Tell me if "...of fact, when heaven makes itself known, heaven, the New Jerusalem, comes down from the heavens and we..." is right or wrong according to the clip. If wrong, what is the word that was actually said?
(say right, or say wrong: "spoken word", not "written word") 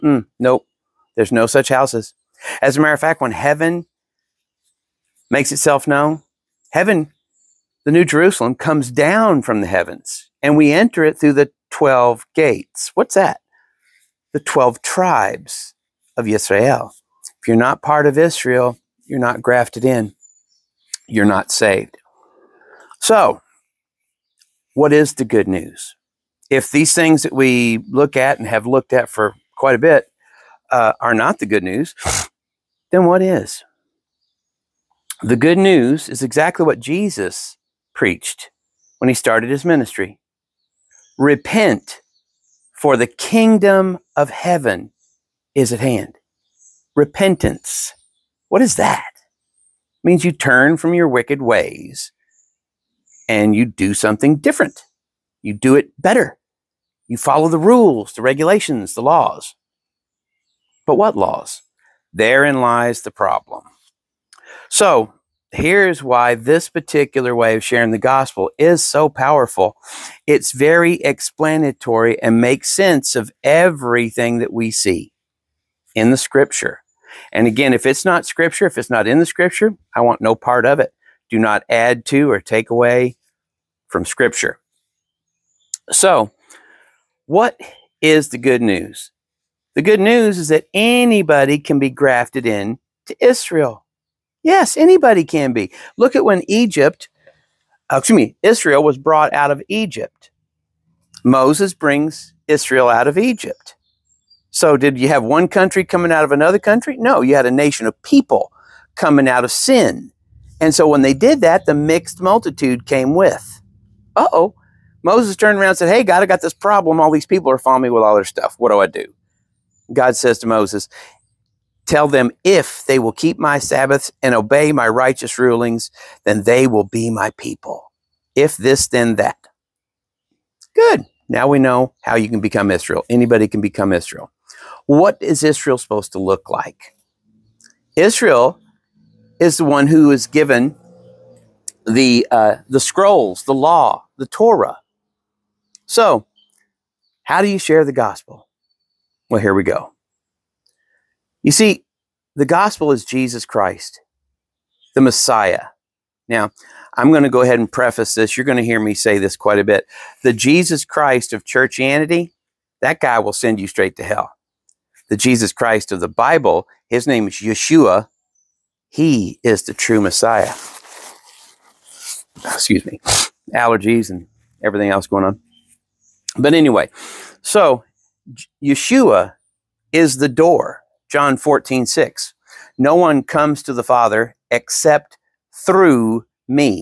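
right.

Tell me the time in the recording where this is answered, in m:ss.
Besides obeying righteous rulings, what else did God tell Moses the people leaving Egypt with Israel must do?
2:03.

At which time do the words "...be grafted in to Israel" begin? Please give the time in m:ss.
1:31.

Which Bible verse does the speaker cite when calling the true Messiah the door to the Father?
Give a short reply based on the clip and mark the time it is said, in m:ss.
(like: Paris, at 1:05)
John 14:6, at 3:01.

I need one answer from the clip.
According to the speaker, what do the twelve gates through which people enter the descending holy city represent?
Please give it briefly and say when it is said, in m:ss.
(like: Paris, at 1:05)
The 12 tribes of Israel, at 0:14.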